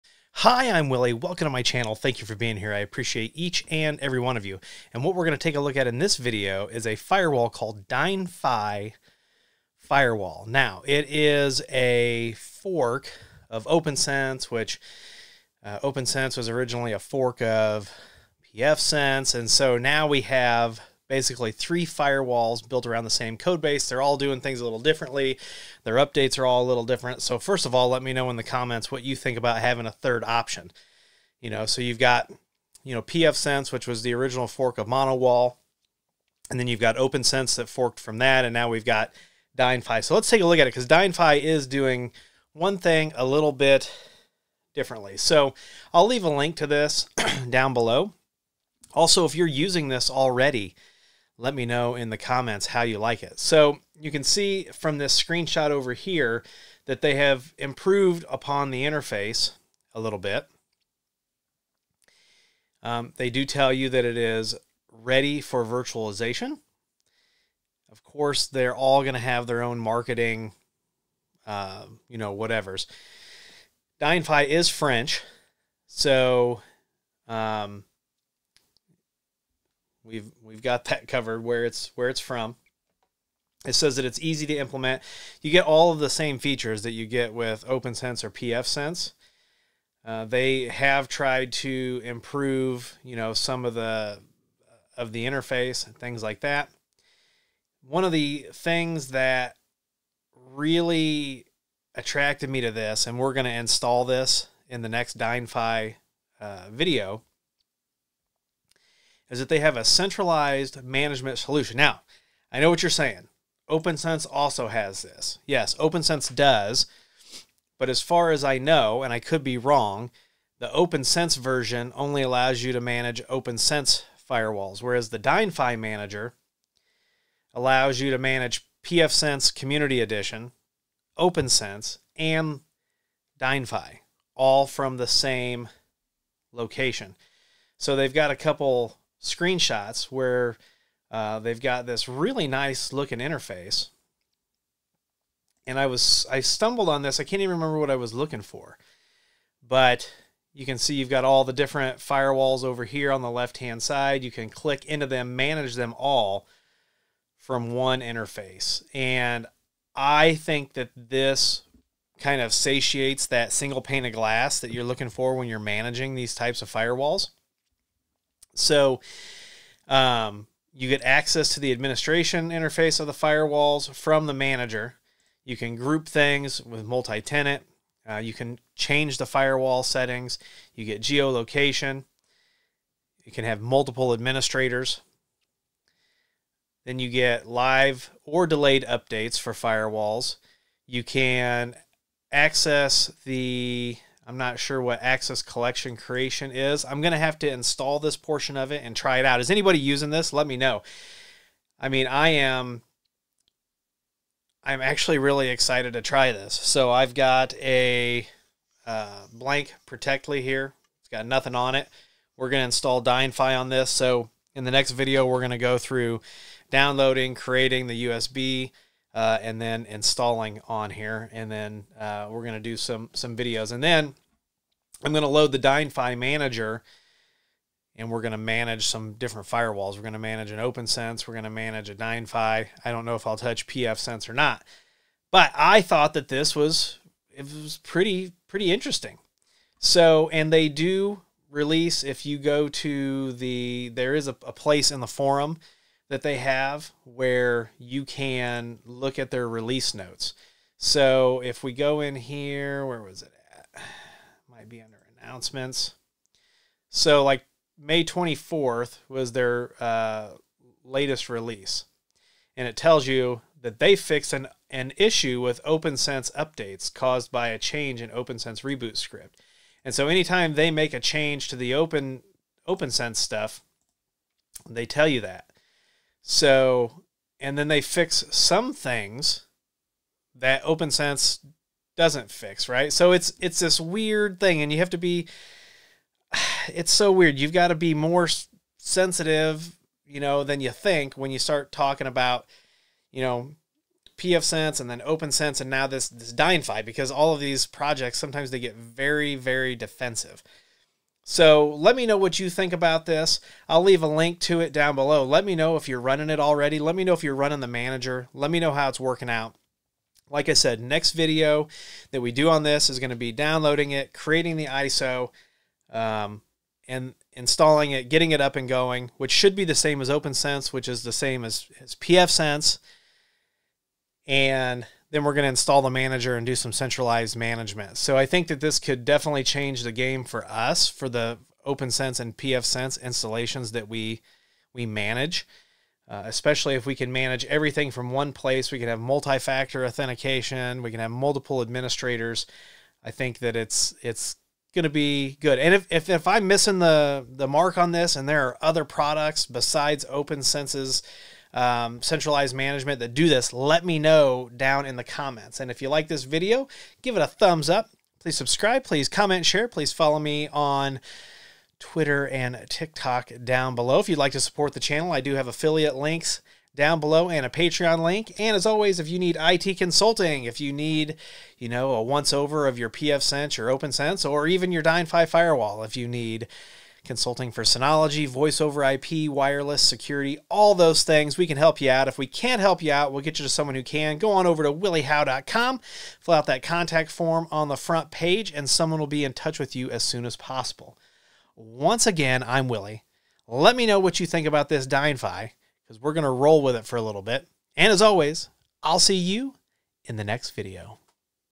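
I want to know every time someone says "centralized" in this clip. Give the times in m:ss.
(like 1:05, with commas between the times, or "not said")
1:49, 5:26, 5:52.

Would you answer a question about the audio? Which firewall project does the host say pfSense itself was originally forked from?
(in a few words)
Monowall.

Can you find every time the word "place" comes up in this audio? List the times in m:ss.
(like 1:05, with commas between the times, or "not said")
4:04, 5:38.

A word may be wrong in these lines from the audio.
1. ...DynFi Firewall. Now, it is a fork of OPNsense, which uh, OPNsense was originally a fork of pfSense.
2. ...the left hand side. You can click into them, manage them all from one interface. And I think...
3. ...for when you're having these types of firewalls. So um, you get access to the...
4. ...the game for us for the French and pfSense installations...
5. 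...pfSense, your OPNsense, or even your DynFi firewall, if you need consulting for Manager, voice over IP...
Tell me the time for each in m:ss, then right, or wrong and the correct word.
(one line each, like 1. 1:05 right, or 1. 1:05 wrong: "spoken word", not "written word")
1. 0:07 right
2. 2:33 right
3. 2:45 wrong: "managing", not "having"
4. 5:29 wrong: "OPNsense", not "French"
5. 6:12 wrong: "Synology", not "Manager".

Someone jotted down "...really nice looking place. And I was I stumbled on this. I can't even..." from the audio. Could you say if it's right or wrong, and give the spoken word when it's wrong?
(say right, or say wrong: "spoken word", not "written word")
wrong: "interface", not "place".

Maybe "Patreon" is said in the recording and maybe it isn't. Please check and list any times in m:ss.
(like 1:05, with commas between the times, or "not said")
6:07.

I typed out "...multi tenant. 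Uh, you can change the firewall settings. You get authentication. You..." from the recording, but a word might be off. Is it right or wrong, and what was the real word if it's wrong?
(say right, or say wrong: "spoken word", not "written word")
wrong: "geolocation", not "authentication".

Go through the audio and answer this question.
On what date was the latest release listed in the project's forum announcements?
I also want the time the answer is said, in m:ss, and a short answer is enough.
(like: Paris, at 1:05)
May 24th, at 4:17.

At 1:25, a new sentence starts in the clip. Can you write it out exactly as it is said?
You get all of the same features that you get with OPNsense or pfSense.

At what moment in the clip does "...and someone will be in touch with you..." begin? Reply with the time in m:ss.
6:28.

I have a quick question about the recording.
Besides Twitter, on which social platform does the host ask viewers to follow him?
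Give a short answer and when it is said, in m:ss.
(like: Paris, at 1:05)
TikTok, at 6:02.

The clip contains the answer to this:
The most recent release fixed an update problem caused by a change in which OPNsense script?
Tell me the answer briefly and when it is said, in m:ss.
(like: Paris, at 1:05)
reboot script, at 4:28.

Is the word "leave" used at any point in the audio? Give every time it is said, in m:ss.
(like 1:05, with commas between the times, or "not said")
0:46, 5:03.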